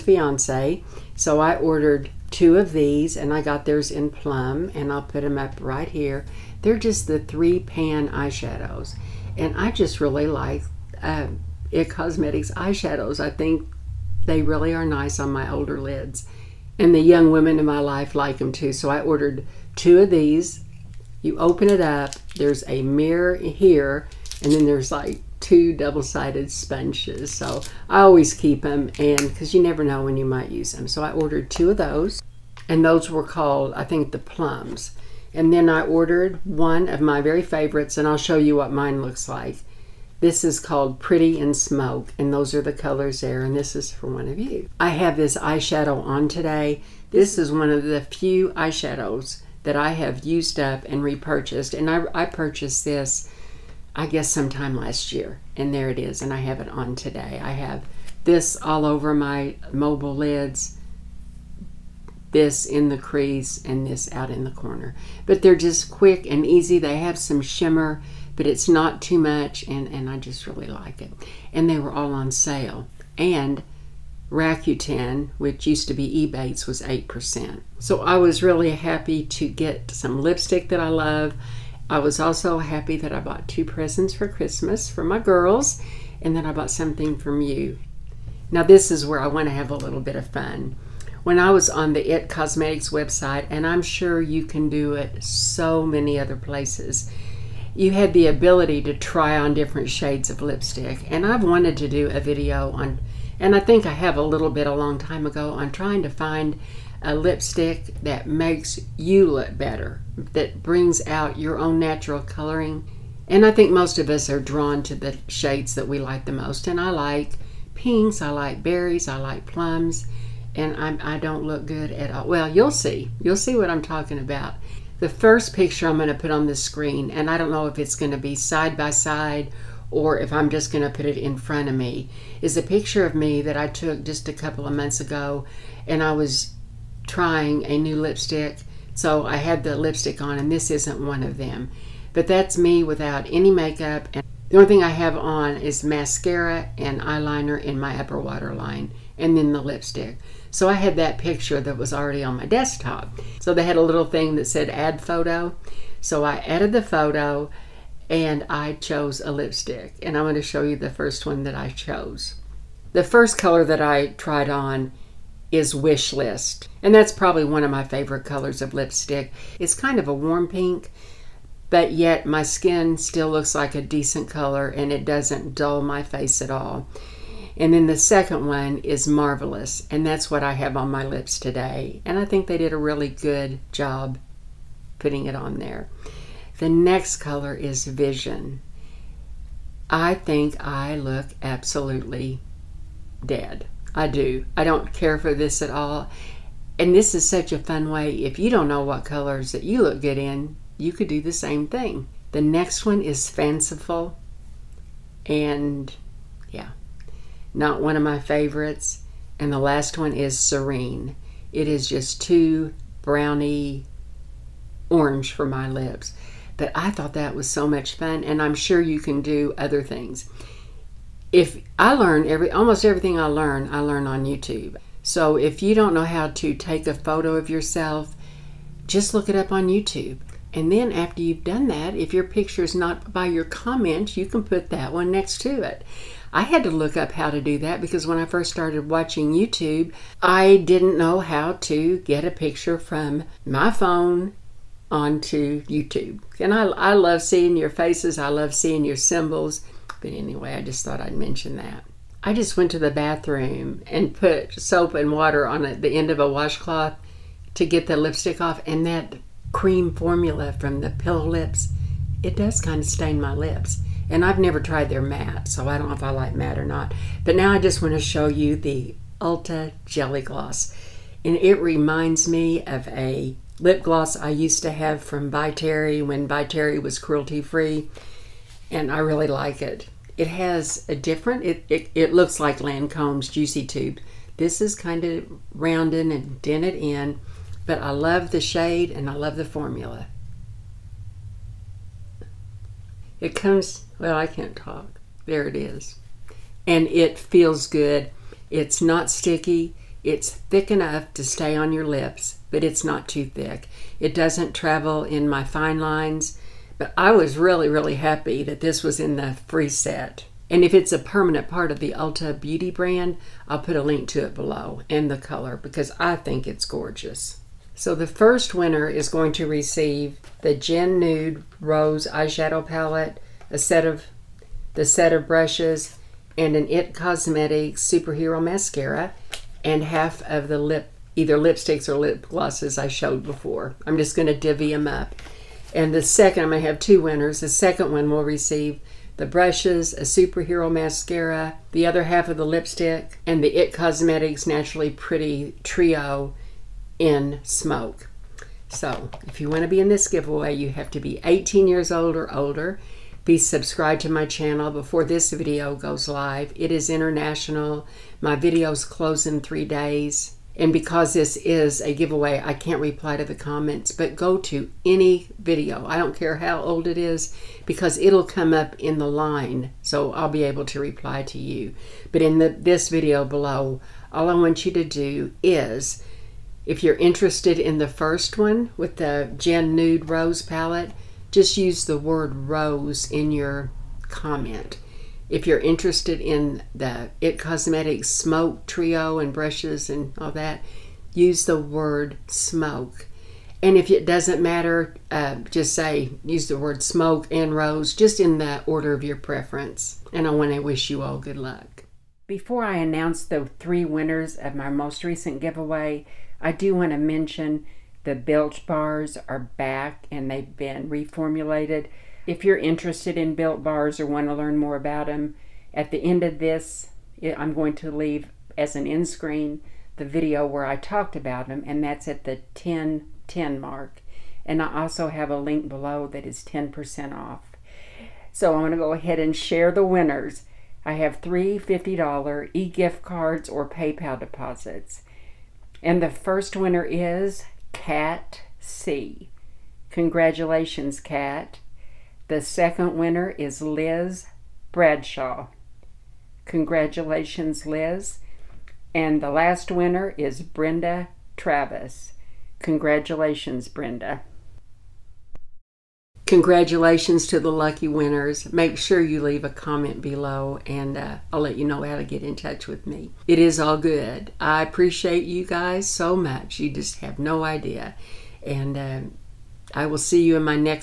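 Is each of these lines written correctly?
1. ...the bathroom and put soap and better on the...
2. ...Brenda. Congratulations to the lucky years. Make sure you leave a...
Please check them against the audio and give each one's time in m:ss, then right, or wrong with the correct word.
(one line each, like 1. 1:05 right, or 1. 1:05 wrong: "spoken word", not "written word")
1. 4:12 wrong: "water", not "better"
2. 7:33 wrong: "winners", not "years".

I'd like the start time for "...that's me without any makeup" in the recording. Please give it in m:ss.
2:22.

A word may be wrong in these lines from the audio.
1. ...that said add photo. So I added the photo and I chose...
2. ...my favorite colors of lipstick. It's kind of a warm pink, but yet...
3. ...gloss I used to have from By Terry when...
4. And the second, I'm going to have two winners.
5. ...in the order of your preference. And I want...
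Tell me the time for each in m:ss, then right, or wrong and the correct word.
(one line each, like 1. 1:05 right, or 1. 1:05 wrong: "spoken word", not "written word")
1. 2:34 right
2. 2:47 right
3. 4:33 right
4. 5:35 right
5. 6:38 right.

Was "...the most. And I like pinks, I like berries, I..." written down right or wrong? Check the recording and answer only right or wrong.
right.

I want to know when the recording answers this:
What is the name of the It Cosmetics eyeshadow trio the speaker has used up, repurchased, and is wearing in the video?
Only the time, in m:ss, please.
0:40.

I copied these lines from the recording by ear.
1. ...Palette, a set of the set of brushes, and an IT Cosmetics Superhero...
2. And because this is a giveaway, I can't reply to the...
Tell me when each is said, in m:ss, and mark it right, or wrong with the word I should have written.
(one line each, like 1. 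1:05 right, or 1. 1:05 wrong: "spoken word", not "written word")
1. 5:22 right
2. 6:00 right.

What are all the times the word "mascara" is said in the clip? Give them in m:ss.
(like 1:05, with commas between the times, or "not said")
2:25, 5:28, 5:40.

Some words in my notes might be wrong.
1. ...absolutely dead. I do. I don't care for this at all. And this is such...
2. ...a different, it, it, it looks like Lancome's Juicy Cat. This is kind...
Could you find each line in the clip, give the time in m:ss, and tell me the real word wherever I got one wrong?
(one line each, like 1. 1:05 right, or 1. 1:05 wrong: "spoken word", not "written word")
1. 3:11 right
2. 4:40 wrong: "Tube", not "Cat".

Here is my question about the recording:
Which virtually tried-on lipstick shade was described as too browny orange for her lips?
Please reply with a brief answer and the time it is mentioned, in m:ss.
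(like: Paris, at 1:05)
Serene, at 3:30.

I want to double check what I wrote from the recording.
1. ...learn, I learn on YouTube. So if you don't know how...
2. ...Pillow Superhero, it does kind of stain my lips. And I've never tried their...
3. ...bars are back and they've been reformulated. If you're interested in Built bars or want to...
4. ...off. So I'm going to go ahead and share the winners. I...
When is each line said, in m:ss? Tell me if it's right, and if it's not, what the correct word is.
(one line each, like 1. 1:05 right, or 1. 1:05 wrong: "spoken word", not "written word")
1. 3:43 right
2. 4:20 wrong: "Lips", not "Superhero"
3. 6:48 right
4. 7:07 right.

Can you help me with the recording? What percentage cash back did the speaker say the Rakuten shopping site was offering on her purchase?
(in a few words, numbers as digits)
8%.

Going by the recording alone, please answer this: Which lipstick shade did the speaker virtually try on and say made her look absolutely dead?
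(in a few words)
Vision.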